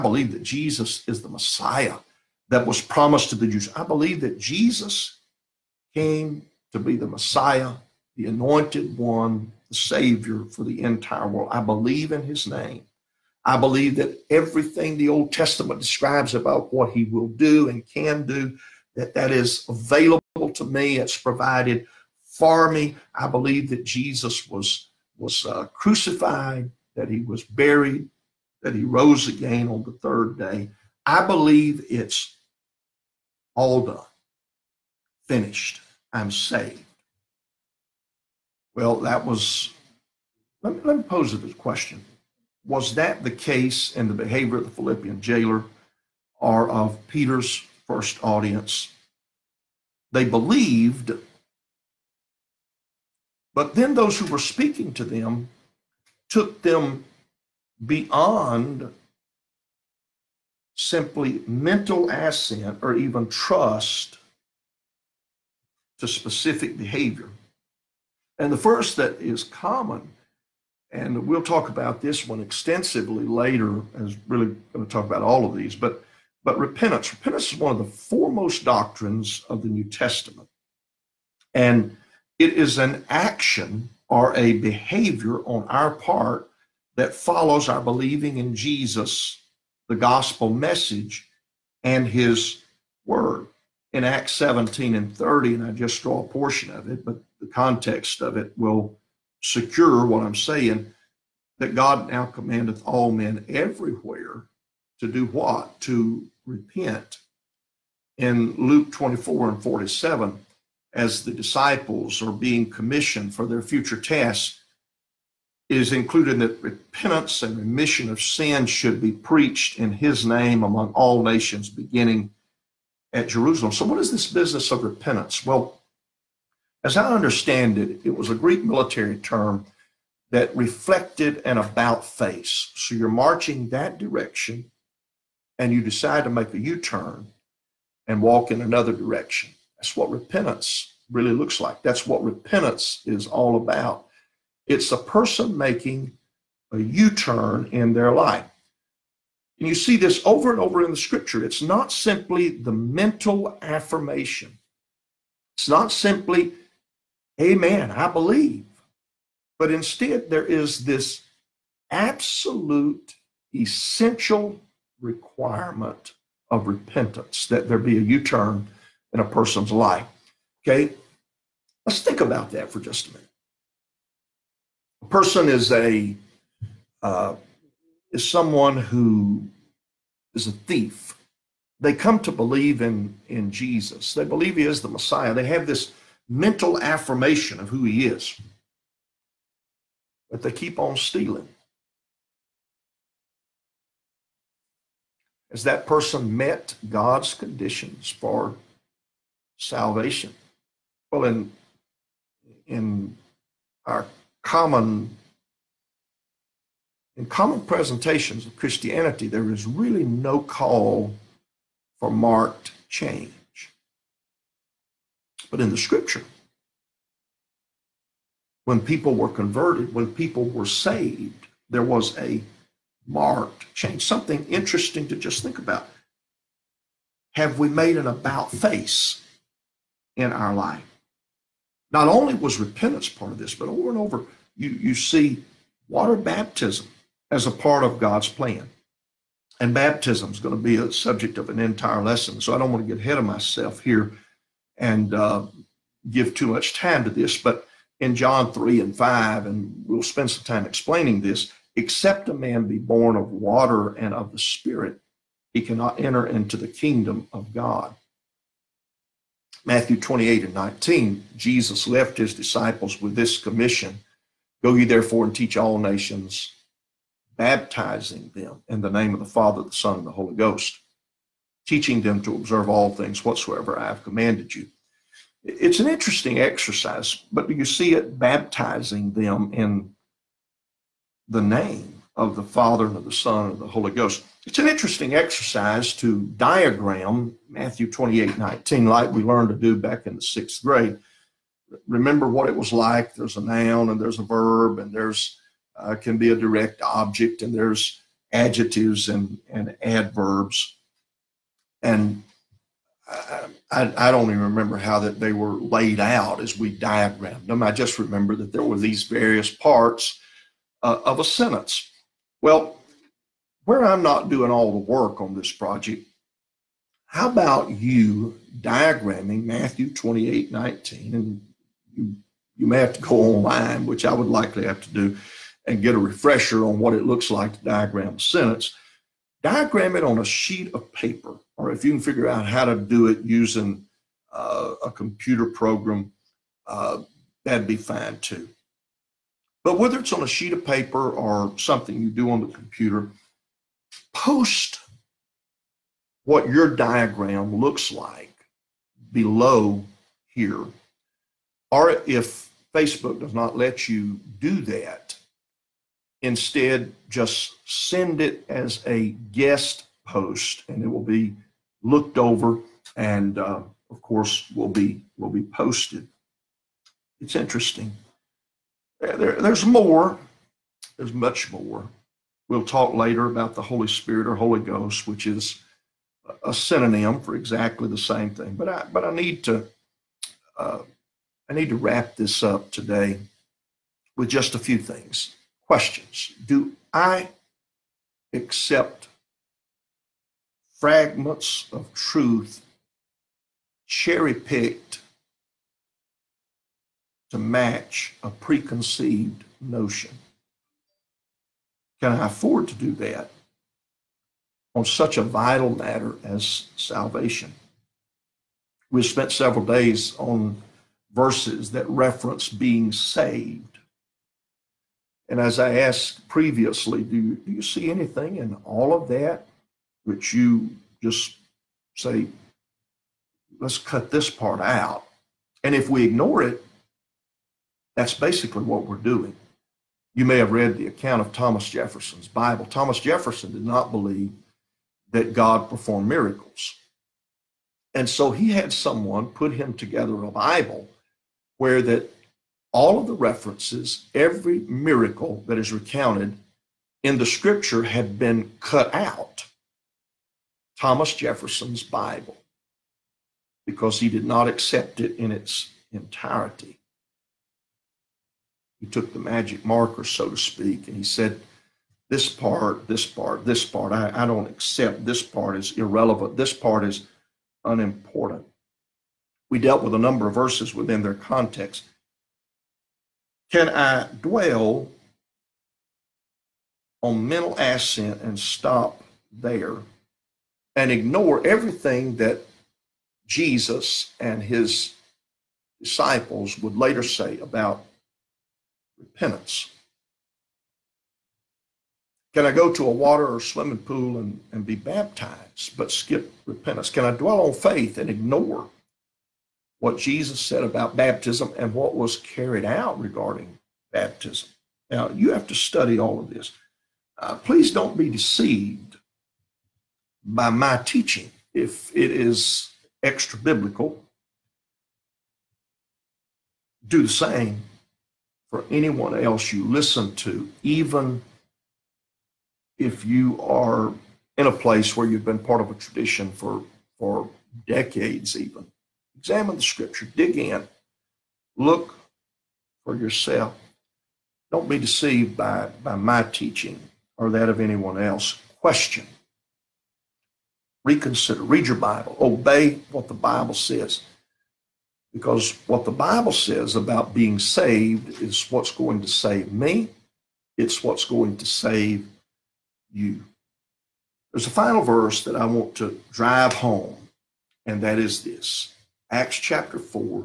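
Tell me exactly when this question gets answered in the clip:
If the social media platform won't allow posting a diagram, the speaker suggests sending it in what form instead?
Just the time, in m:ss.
5:59.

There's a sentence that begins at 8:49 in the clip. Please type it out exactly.
Examine the scripture, dig in, look for yourself.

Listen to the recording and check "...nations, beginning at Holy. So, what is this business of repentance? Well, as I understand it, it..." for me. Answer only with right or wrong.
wrong.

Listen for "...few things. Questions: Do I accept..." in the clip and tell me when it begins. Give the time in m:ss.
6:24.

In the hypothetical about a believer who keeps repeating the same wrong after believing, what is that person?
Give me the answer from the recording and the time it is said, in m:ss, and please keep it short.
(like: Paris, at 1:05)
A thief, at 3:00.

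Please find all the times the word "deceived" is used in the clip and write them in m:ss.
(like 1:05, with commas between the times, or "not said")
8:28, 8:54.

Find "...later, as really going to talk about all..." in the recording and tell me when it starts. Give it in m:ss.
1:13.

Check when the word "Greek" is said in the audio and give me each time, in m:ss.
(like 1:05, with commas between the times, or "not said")
2:08.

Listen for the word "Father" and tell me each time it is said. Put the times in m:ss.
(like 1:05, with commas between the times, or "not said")
4:29, 4:42.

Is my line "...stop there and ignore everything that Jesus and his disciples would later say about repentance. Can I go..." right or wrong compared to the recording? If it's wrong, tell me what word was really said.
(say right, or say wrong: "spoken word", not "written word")
right.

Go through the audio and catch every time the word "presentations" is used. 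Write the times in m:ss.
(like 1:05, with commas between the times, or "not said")
3:27.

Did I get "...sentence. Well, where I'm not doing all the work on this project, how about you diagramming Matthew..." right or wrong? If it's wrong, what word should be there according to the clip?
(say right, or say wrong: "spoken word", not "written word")
right.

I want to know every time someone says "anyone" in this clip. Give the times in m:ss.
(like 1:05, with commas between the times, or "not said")
8:38, 8:57.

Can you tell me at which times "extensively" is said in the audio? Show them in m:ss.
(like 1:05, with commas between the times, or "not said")
1:12.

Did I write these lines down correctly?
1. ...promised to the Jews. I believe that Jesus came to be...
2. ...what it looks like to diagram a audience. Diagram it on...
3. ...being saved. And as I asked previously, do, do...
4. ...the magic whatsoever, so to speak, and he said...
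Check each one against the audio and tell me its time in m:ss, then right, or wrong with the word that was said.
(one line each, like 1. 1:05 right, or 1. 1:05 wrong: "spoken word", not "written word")
1. 0:02 right
2. 5:26 wrong: "sentence", not "audience"
3. 6:52 right
4. 7:39 wrong: "marker", not "whatsoever".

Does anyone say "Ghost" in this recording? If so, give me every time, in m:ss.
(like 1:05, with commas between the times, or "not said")
4:30, 4:43, 6:14.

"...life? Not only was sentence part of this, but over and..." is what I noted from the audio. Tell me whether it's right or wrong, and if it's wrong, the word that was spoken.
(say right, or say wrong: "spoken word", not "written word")
wrong: "repentance", not "sentence".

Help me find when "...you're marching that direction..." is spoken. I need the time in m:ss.
2:12.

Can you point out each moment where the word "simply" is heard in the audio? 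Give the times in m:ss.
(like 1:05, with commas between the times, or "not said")
1:00, 2:31, 2:35.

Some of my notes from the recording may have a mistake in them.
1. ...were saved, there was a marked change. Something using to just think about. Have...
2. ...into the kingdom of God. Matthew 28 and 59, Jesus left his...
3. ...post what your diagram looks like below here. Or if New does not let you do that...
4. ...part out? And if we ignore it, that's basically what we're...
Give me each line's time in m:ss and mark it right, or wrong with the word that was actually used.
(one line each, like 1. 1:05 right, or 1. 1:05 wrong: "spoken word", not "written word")
1. 3:40 wrong: "interesting", not "using"
2. 4:16 wrong: "19", not "59"
3. 5:44 wrong: "Facebook", not "New"
4. 7:04 right.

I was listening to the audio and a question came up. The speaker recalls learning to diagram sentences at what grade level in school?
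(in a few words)
Sixth grade.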